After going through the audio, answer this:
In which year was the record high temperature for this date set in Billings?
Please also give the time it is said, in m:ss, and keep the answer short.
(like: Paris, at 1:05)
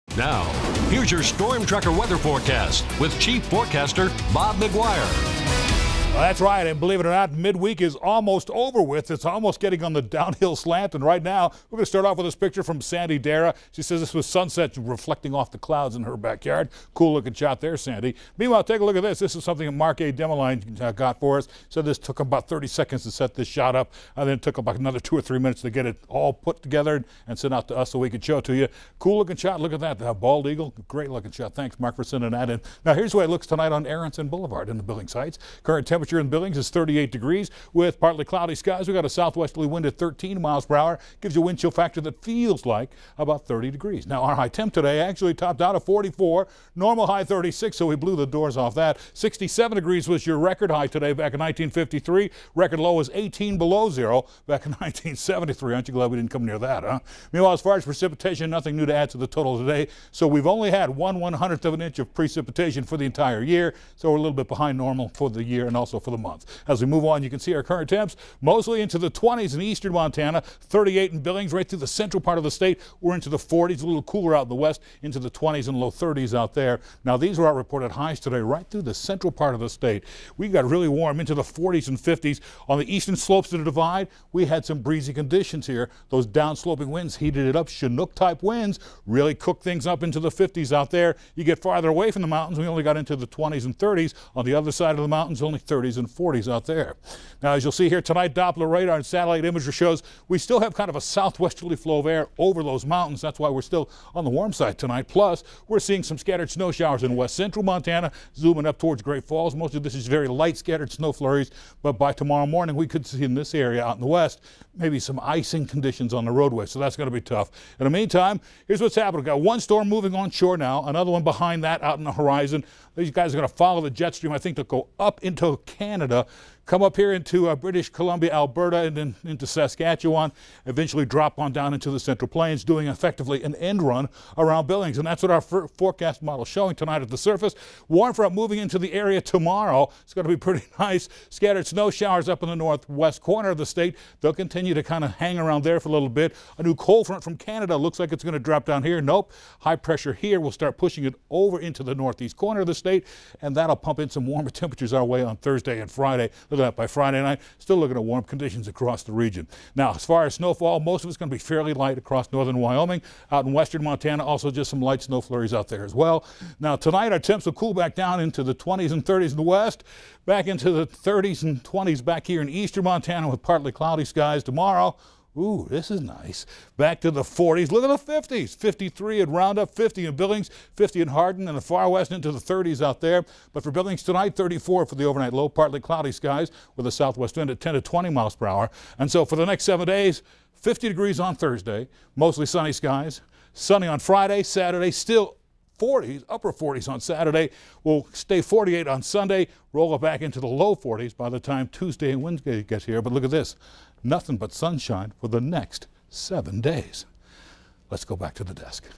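1953, at 0:51.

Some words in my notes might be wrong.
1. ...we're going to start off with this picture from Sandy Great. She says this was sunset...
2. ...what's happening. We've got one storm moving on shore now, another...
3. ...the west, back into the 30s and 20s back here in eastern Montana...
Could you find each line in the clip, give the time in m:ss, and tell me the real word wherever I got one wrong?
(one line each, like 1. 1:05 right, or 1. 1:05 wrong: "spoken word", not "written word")
1. 0:11 wrong: "Dara", not "Great"
2. 1:58 right
3. 2:49 right.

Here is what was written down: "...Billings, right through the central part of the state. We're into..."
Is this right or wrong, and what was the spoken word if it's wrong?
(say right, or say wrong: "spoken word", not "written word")
right.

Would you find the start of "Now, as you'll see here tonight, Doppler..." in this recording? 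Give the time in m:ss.
1:37.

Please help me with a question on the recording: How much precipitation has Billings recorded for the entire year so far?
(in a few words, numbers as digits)
One hundredth of an inch.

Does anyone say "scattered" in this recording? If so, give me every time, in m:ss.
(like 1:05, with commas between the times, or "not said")
1:46, 1:50, 2:21.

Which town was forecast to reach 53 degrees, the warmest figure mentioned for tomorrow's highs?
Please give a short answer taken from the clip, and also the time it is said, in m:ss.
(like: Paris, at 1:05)
Roundup, at 2:59.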